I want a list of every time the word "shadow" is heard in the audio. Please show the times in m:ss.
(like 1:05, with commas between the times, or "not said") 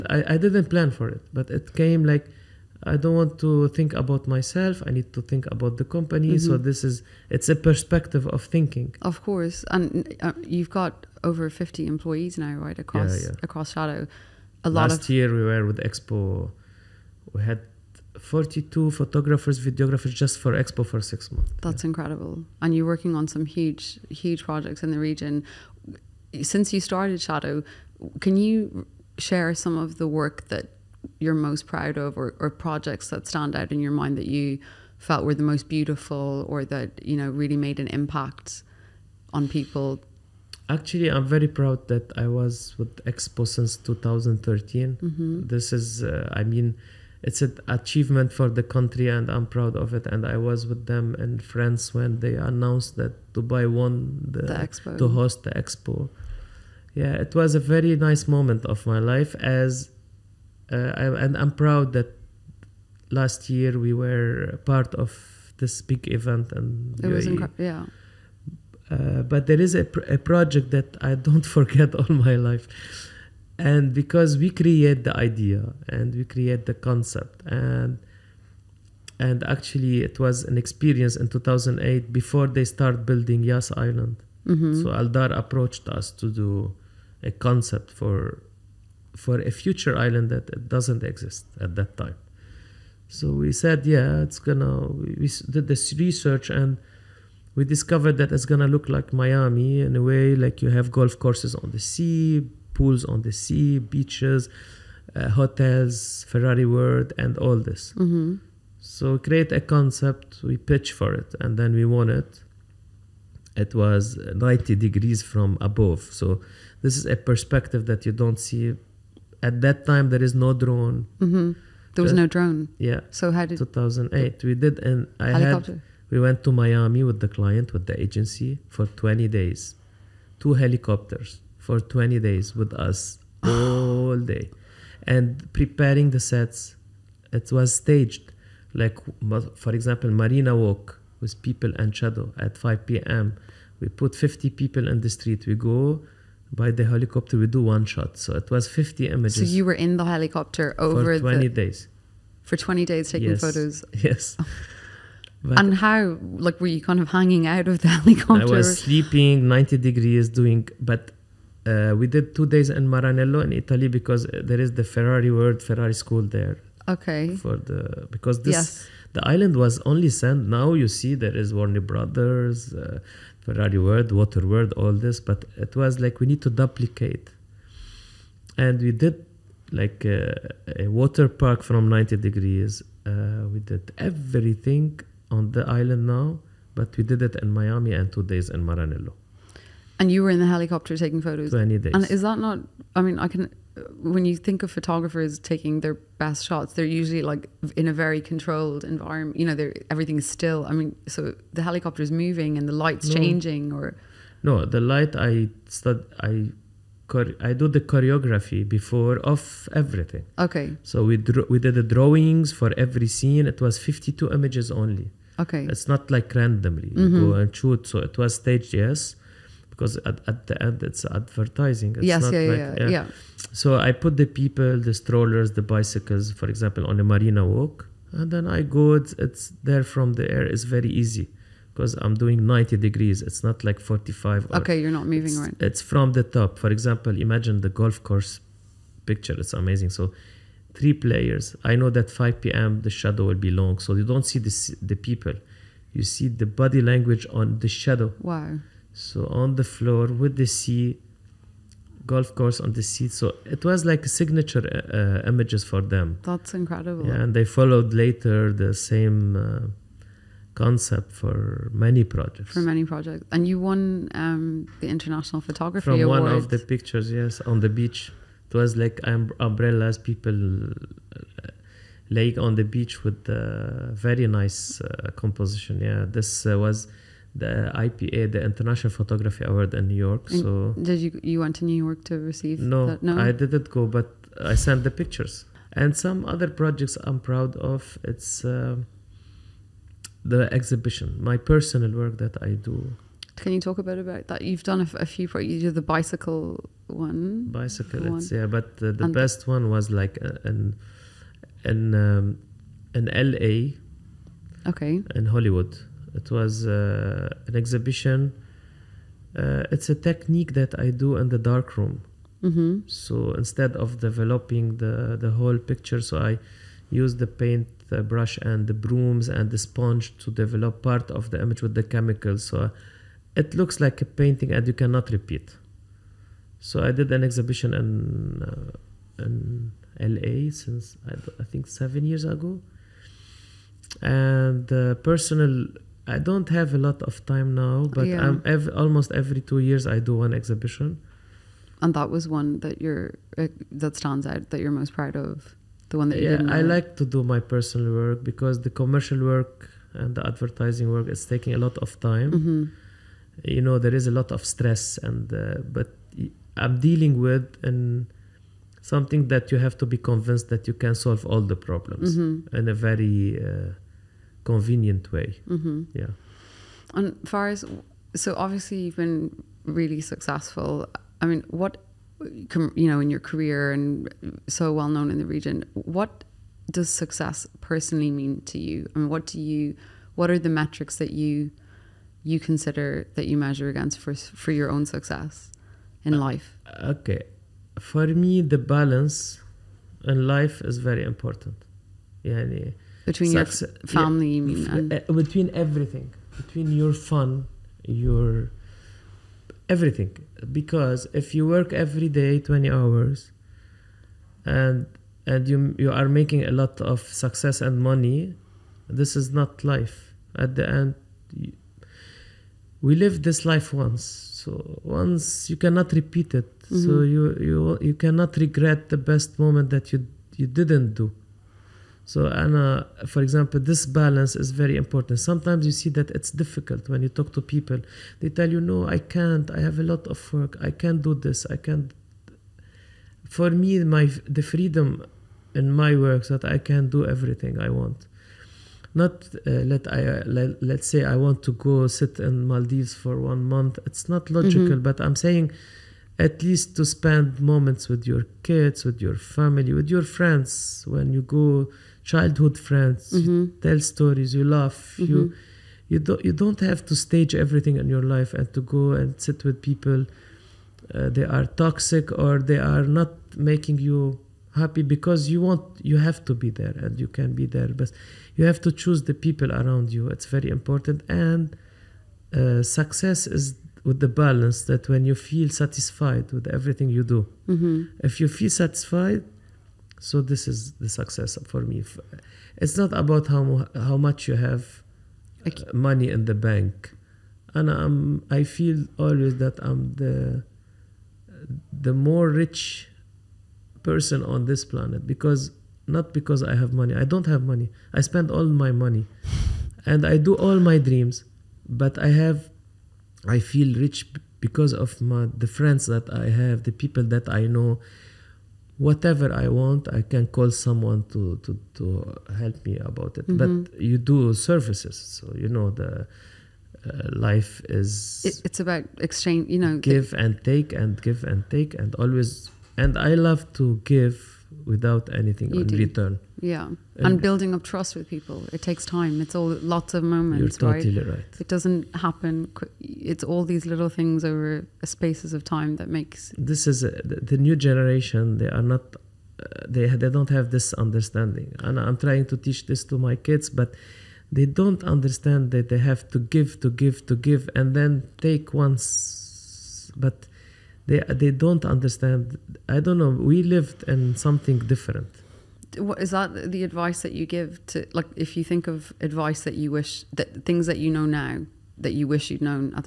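0:13, 0:27, 2:21, 4:02, 4:07.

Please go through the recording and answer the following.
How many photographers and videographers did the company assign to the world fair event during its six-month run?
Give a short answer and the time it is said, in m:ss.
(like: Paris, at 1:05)
42, at 0:18.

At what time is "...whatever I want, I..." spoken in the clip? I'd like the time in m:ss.
8:28.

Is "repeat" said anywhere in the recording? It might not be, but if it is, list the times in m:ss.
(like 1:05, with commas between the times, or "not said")
5:25, 6:55.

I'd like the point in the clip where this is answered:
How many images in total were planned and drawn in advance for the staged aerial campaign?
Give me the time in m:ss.
3:33.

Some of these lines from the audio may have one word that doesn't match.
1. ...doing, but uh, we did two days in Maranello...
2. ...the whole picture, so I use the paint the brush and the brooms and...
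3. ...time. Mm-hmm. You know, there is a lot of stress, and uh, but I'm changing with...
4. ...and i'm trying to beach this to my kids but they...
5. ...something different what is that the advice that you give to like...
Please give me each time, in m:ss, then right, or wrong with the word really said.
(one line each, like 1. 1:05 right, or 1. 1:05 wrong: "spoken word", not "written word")
1. 2:40 right
2. 5:15 right
3. 5:51 wrong: "dealing", not "changing"
4. 9:01 wrong: "teach", not "beach"
5. 9:14 right.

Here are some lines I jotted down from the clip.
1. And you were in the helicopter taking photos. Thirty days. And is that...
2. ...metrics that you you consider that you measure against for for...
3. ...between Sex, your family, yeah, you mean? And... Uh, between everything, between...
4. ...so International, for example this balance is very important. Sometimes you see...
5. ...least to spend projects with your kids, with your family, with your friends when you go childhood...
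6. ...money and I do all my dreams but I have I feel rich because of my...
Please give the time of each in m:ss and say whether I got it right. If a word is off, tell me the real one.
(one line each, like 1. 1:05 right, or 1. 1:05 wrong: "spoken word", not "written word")
1. 3:09 wrong: "Twenty", not "Thirty"
2. 6:20 right
3. 6:33 right
4. 7:02 wrong: "Anna", not "International"
5. 7:26 wrong: "moments", not "projects"
6. 8:18 right.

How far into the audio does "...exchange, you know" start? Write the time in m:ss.
8:38.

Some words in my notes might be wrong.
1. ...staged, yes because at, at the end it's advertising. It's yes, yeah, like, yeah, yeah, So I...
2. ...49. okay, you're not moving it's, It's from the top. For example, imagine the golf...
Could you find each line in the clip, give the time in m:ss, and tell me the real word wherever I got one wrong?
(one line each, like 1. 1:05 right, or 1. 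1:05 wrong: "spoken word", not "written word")
1. 3:38 right
2. 3:53 wrong: "45", not "49".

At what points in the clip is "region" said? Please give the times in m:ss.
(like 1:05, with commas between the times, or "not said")
0:24, 6:15.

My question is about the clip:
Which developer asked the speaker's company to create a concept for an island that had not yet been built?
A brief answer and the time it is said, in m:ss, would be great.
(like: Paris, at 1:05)
Aldar, at 1:24.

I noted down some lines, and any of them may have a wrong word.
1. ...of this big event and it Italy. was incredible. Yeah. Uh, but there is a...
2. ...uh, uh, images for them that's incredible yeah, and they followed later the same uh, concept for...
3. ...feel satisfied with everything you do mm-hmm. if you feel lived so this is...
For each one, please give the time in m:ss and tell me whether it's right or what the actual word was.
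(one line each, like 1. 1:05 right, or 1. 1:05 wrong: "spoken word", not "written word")
1. 1:04 wrong: "UAE", not "Italy"
2. 4:14 right
3. 7:55 wrong: "satisfied", not "lived".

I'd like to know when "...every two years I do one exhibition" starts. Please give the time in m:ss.
5:39.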